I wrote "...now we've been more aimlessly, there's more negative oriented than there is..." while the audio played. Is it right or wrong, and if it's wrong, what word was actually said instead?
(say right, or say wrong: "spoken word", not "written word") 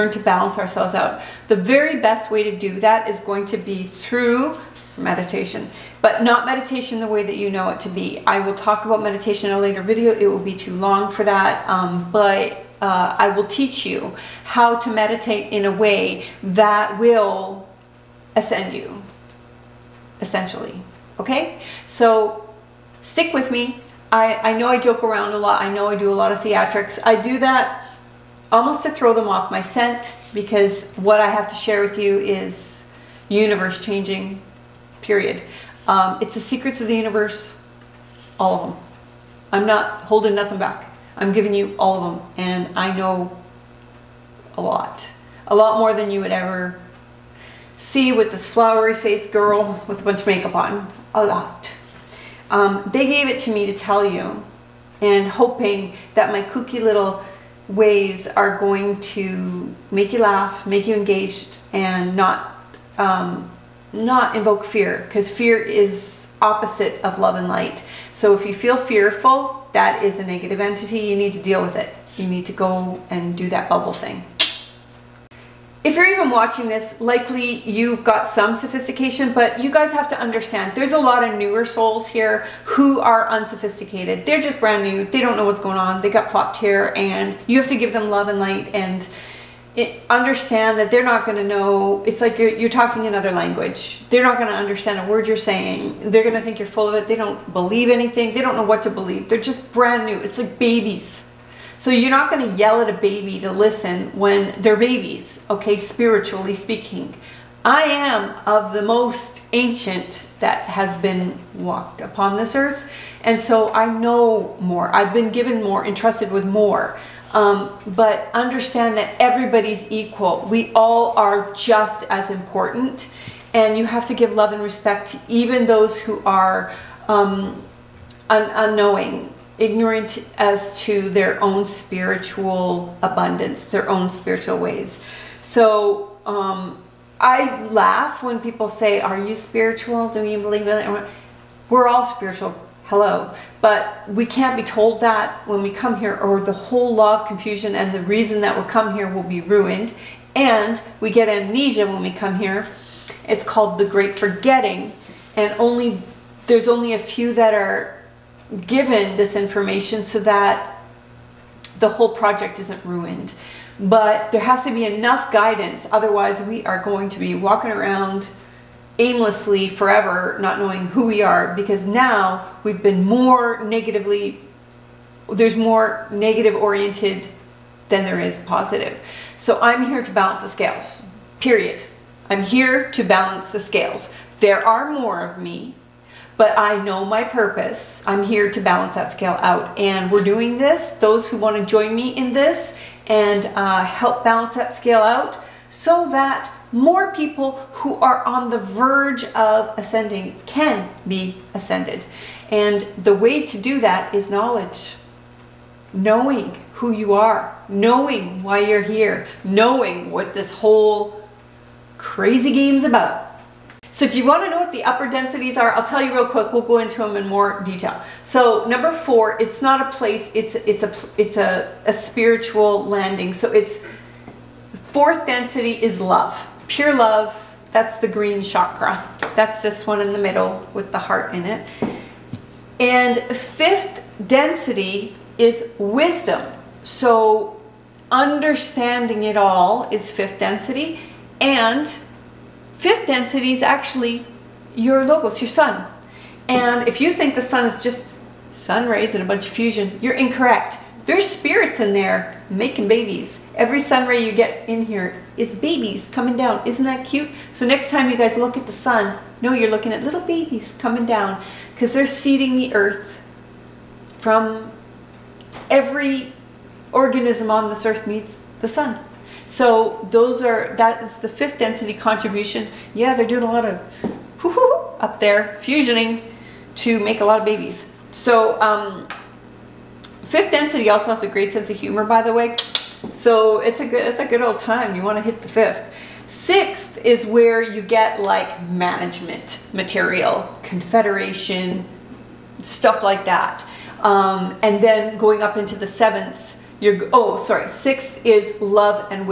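wrong: "negatively", not "aimlessly".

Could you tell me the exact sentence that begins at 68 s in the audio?
So if you feel fearful, that is a negative entity.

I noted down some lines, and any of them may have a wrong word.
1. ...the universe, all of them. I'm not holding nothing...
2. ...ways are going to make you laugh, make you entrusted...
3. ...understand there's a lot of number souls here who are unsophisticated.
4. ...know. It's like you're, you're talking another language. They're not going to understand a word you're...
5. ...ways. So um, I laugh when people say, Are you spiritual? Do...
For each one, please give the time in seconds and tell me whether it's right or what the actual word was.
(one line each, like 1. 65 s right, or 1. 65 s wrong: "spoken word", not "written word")
1. 36 s right
2. 57 s wrong: "engaged", not "entrusted"
3. 80 s wrong: "newer", not "number"
4. 91 s right
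5. 134 s right.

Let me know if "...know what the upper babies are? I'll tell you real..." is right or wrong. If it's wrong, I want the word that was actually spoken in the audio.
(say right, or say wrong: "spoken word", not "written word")
wrong: "densities", not "babies".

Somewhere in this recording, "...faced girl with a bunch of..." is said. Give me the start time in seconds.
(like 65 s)
48 s.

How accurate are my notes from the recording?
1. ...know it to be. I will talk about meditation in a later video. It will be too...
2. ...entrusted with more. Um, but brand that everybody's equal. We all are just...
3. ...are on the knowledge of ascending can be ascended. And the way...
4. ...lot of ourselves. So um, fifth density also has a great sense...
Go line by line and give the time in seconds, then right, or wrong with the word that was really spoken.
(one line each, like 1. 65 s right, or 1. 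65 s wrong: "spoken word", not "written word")
1. 7 s right
2. 115 s wrong: "understand", not "brand"
3. 197 s wrong: "verge", not "knowledge"
4. 277 s wrong: "babies", not "ourselves".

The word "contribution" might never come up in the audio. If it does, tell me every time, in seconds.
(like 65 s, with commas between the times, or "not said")
271 s.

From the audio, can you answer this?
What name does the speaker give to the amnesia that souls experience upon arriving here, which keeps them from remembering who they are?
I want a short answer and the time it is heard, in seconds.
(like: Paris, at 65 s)
The Great Forgetting, at 153 s.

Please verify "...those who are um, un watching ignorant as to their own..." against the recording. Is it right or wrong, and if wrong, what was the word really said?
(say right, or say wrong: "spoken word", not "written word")
wrong: "unknowing", not "watching".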